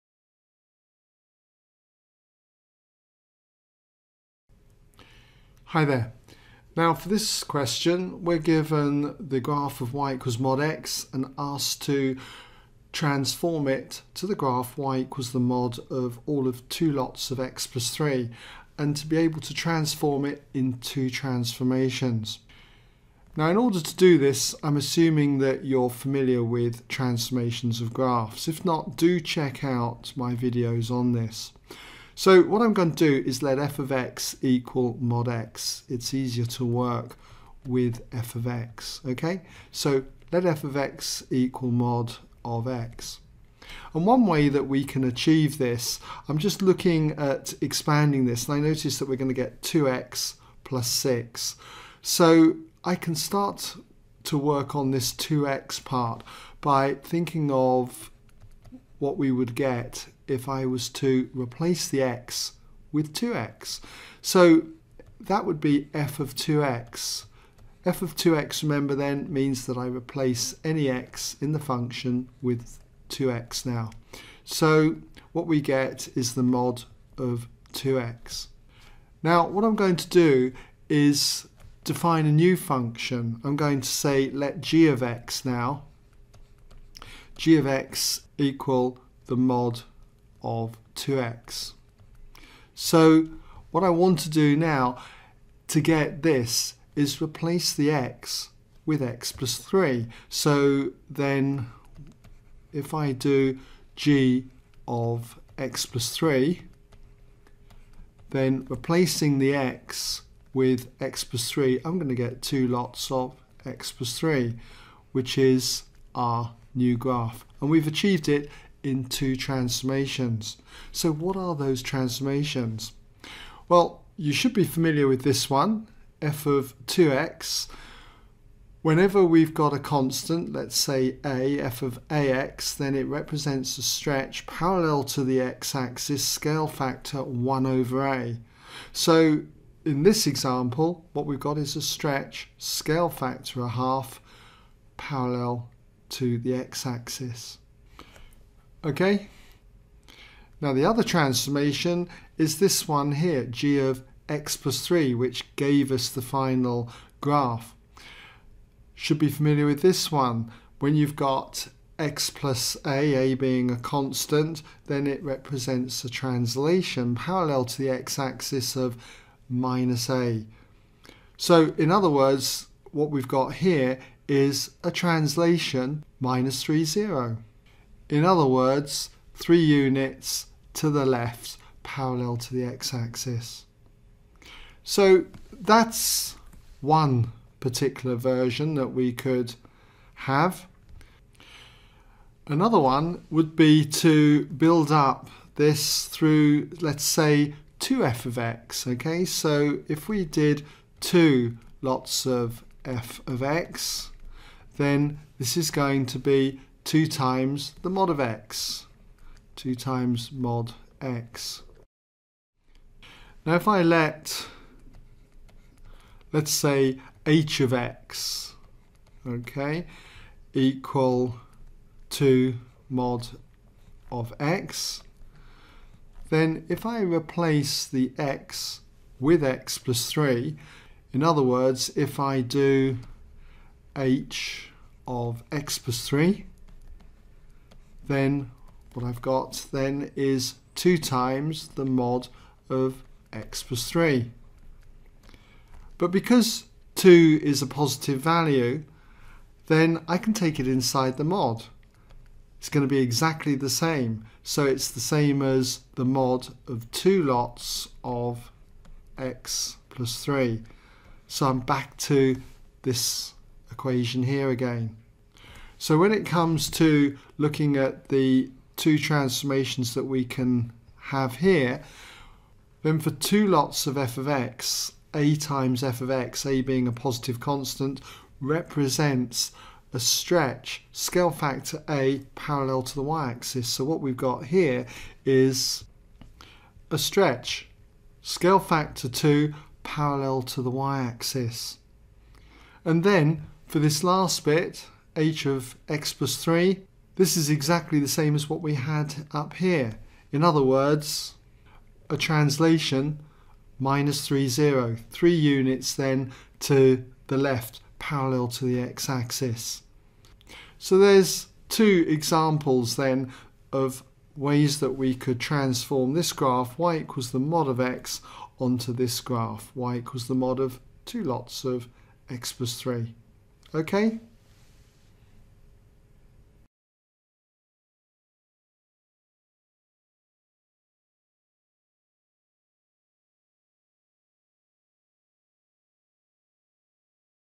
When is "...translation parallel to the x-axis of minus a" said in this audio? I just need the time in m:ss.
2:46.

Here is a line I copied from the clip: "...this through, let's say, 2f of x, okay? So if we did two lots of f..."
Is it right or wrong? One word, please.
right.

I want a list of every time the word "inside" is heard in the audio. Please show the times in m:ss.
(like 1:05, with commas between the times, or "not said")
4:10.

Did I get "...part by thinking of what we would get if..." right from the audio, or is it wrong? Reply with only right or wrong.
right.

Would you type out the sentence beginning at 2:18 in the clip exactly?
So in this example, what we've got is a stretch scale factor a half parallel to the x-axis.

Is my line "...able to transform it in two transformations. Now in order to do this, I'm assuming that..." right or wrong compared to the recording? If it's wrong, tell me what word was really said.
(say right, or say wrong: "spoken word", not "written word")
right.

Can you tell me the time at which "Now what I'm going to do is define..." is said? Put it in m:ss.
1:19.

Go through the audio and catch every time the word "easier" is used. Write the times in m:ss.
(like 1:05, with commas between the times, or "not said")
0:36.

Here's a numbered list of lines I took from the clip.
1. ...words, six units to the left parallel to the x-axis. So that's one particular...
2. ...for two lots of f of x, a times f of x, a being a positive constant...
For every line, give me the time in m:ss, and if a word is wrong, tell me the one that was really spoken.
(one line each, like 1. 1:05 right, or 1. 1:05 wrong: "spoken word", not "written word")
1. 2:58 wrong: "three", not "six"
2. 4:32 right.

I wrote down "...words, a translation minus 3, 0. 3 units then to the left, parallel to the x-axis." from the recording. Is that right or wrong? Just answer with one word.
right.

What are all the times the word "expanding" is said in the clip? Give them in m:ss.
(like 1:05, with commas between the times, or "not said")
0:47.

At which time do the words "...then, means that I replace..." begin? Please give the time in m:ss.
1:08.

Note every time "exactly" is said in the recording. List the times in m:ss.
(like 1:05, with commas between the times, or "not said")
4:12, 4:57.